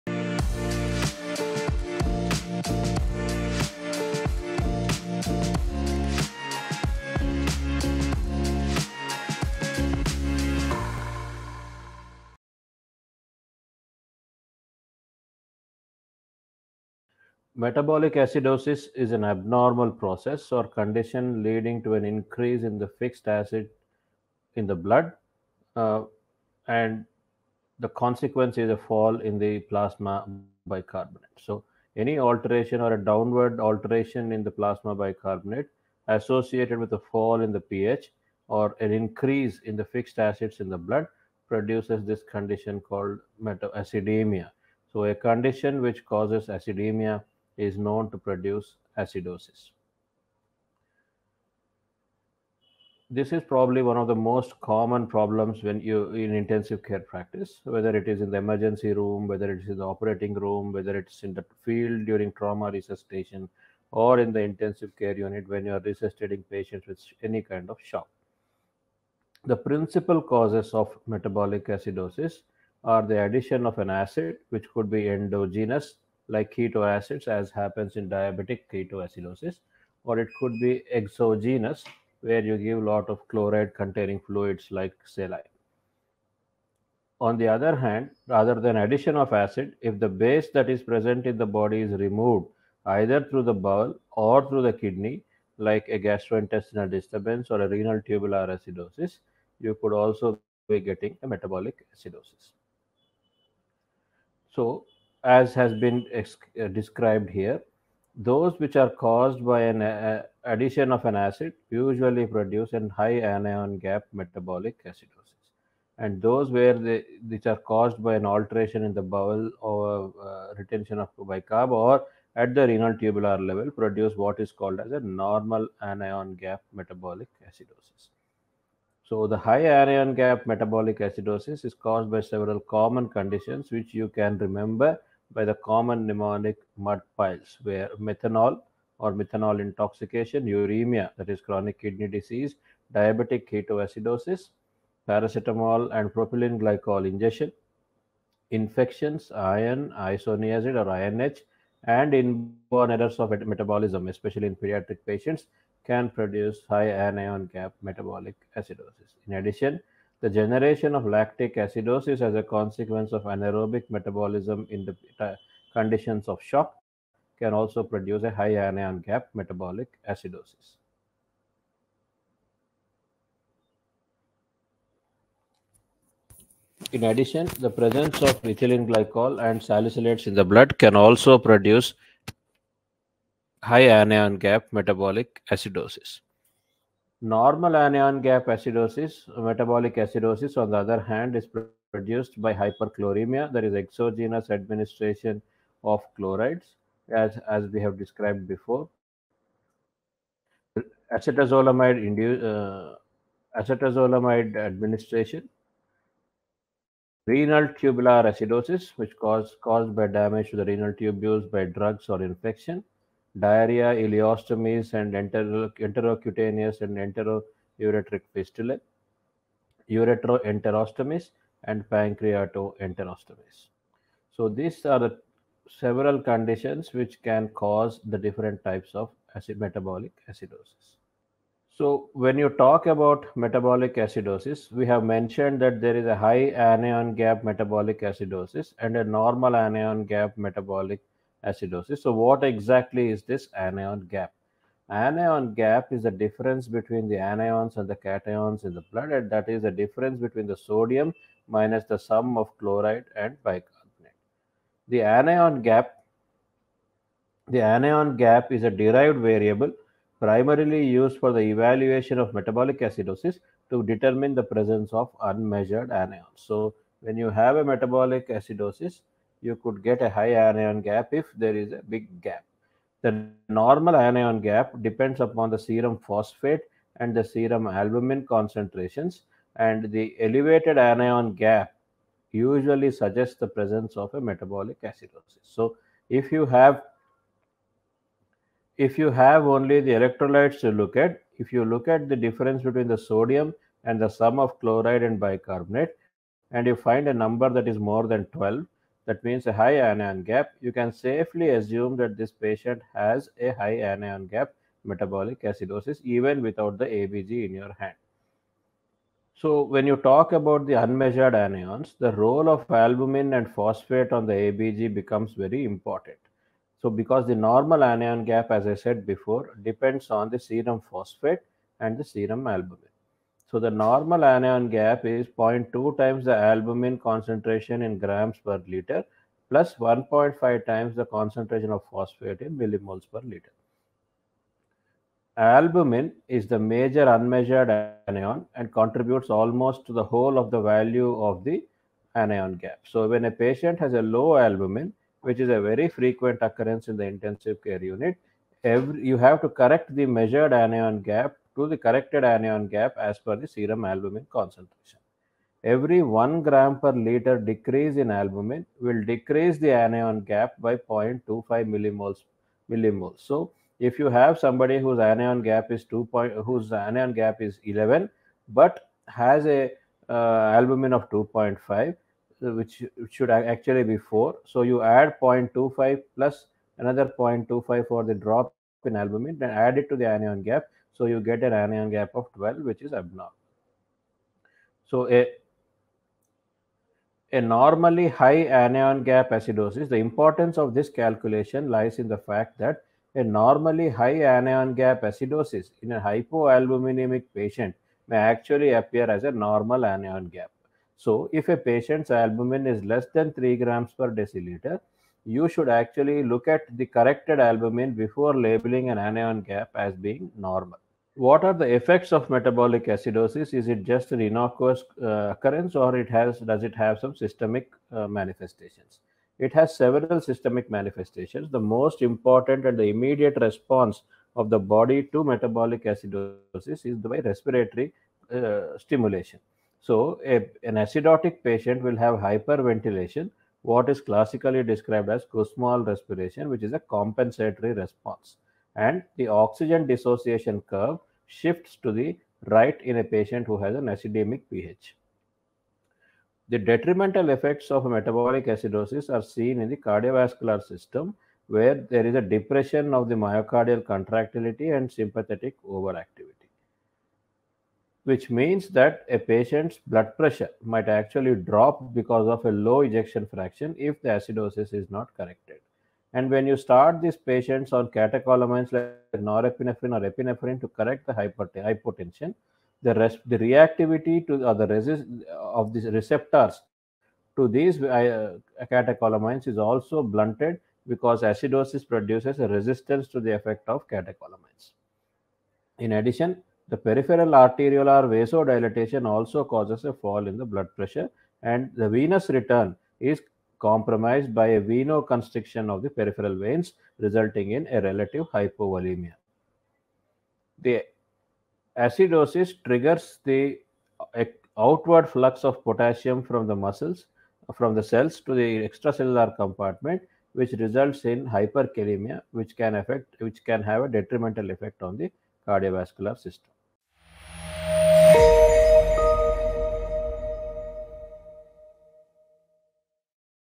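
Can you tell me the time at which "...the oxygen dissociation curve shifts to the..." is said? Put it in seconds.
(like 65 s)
439 s.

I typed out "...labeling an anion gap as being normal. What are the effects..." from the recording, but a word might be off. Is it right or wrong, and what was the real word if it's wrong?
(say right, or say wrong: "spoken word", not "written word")
right.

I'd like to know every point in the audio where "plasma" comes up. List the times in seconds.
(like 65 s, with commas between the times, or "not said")
29 s, 34 s.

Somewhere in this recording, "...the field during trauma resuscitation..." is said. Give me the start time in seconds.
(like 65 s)
61 s.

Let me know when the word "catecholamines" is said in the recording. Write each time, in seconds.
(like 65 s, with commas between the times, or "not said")
467 s, 478 s, 483 s.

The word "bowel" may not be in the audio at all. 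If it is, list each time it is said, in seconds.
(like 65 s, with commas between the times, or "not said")
93 s, 119 s.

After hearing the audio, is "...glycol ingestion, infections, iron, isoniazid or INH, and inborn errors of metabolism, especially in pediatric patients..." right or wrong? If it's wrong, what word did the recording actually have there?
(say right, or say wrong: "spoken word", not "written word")
right.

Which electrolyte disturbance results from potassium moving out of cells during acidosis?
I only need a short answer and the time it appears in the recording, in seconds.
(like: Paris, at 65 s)
hyperkalemia, at 511 s.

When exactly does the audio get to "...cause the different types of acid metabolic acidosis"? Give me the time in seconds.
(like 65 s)
227 s.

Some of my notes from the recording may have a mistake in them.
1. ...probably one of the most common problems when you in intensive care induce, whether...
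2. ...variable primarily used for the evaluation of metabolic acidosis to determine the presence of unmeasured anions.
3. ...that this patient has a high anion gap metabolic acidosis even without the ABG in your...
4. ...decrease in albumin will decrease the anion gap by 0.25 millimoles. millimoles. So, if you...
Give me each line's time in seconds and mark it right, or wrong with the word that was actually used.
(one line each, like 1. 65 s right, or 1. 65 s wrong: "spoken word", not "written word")
1. 53 s wrong: "practice", not "induce"
2. 259 s right
3. 301 s right
4. 357 s right.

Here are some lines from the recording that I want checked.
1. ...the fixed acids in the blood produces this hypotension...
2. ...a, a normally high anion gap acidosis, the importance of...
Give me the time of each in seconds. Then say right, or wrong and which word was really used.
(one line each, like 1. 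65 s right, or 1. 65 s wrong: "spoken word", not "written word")
1. 39 s wrong: "condition", not "hypotension"
2. 385 s right.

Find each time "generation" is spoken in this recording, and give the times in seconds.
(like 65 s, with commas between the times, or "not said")
160 s.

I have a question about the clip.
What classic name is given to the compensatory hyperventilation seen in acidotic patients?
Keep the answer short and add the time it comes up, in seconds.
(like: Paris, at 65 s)
Kussmaul respiration, at 435 s.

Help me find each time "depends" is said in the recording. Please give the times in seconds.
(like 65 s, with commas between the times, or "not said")
274 s, 319 s.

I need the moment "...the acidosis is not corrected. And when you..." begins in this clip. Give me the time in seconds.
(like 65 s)
464 s.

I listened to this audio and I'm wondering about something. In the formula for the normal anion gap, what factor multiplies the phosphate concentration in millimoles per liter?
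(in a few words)
1.5.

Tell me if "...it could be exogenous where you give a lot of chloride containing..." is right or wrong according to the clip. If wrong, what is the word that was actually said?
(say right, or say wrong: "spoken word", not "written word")
right.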